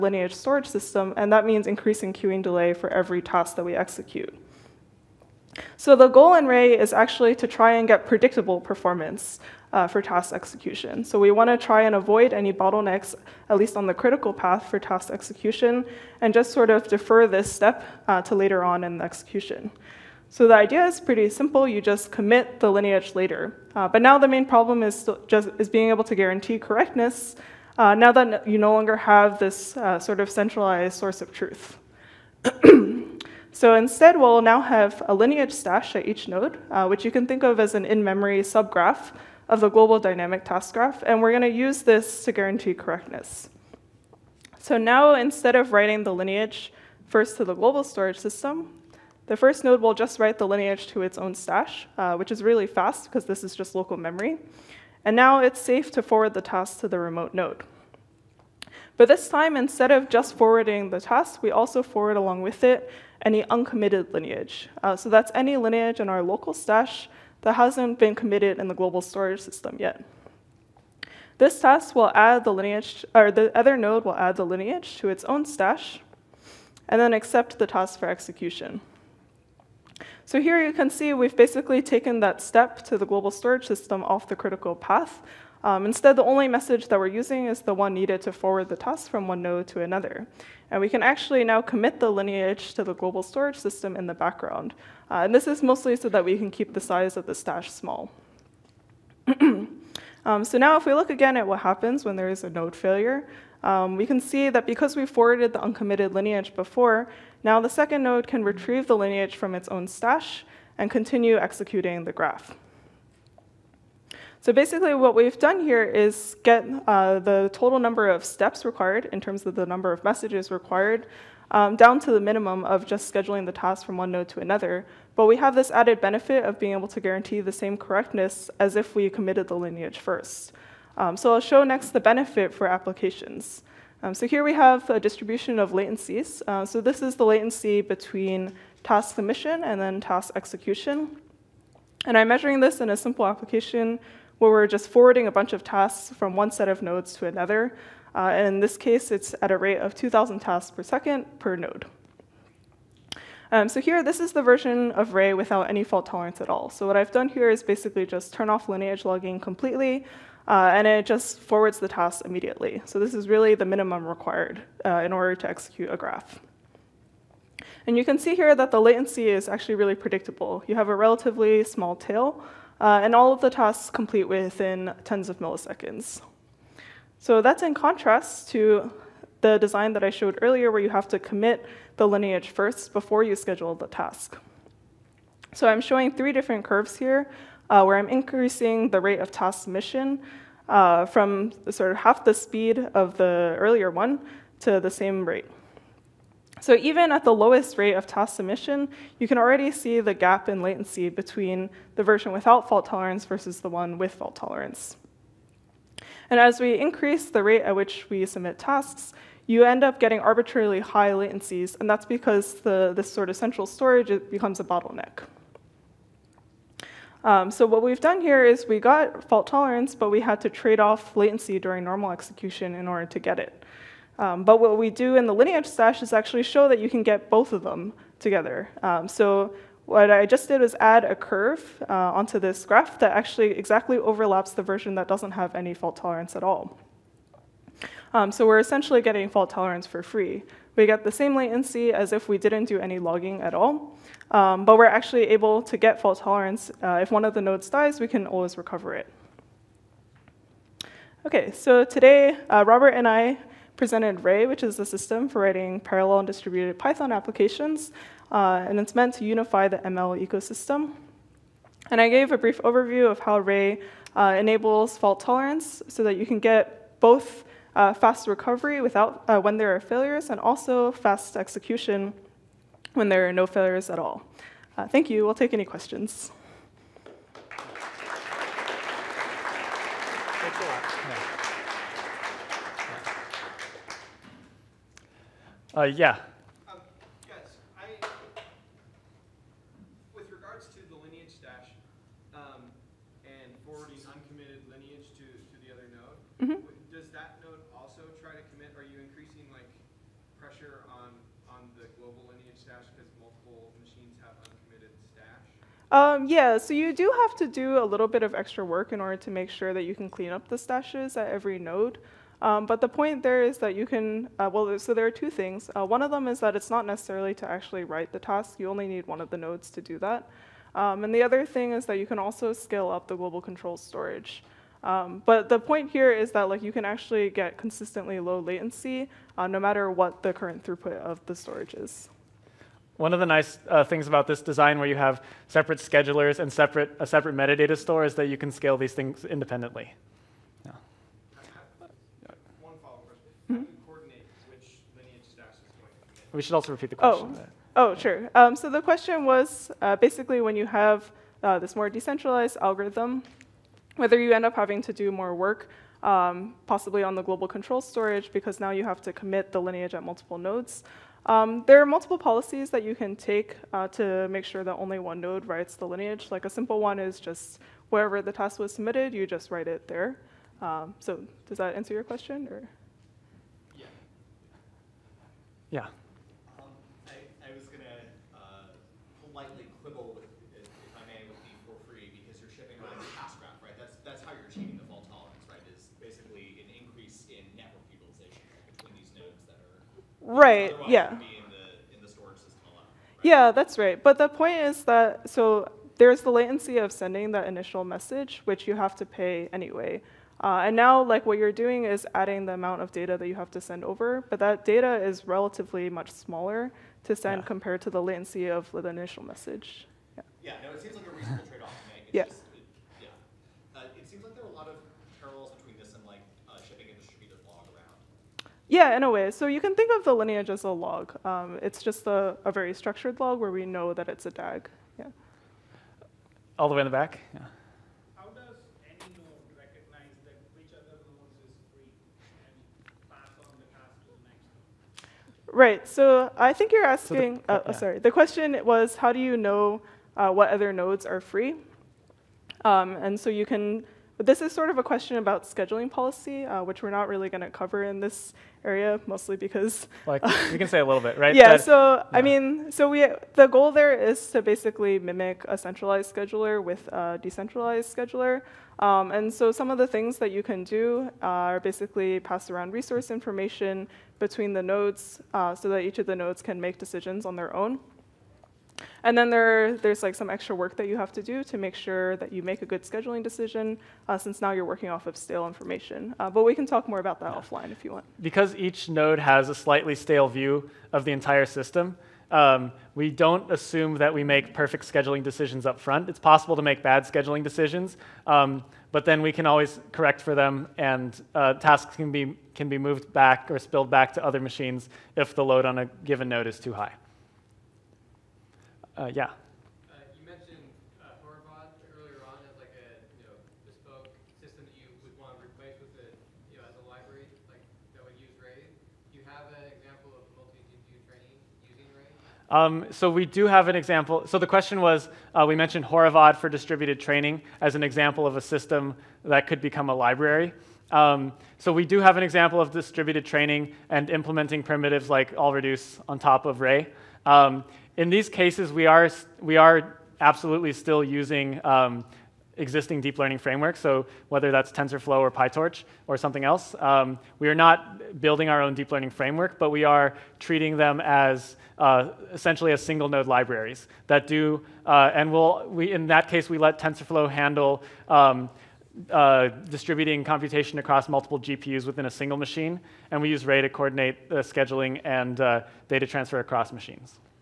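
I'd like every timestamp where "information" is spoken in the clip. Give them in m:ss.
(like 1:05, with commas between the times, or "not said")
7:43, 7:55.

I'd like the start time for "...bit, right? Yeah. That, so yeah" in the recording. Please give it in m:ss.
7:30.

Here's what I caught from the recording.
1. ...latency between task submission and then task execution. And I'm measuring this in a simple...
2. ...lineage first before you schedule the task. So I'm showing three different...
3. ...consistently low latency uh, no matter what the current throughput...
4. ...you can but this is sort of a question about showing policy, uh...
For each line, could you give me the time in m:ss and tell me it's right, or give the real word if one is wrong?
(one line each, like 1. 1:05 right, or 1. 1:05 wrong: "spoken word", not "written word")
1. 2:17 right
2. 3:02 right
3. 5:27 right
4. 7:23 wrong: "scheduling", not "showing".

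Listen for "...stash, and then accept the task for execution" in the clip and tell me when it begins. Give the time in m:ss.
1:15.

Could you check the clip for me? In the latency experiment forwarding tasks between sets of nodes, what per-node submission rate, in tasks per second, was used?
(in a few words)
2,000.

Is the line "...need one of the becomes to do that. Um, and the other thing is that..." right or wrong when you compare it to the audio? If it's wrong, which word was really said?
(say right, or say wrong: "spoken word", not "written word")
wrong: "nodes", not "becomes".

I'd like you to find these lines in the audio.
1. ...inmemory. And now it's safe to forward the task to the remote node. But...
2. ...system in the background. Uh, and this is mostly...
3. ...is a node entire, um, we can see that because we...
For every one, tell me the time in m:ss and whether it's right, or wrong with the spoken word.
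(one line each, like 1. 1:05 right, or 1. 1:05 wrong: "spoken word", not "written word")
1. 0:53 wrong: "memory", not "inmemory"
2. 1:33 right
3. 1:42 wrong: "failure", not "entire".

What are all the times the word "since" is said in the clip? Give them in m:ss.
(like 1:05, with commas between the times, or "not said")
7:54.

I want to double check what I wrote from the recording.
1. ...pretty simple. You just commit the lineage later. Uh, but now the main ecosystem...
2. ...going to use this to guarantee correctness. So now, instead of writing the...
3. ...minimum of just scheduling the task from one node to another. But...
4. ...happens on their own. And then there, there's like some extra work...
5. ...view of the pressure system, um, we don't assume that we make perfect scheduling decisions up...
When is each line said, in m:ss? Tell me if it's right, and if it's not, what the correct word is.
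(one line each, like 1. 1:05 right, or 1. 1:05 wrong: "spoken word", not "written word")
1. 0:20 wrong: "problem", not "ecosystem"
2. 0:41 right
3. 2:02 right
4. 7:46 wrong: "decisions", not "happens"
5. 8:00 wrong: "entire", not "pressure".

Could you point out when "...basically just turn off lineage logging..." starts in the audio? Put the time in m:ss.
2:37.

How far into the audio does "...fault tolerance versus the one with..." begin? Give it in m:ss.
3:22.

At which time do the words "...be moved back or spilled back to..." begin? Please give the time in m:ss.
8:12.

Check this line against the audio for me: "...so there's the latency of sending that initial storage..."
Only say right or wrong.
wrong.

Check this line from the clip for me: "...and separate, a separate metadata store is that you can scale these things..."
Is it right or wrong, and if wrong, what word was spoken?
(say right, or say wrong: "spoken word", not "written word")
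right.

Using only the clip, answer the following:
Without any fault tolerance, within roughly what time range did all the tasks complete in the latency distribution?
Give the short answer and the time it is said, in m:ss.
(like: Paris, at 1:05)
tens of milliseconds, at 2:55.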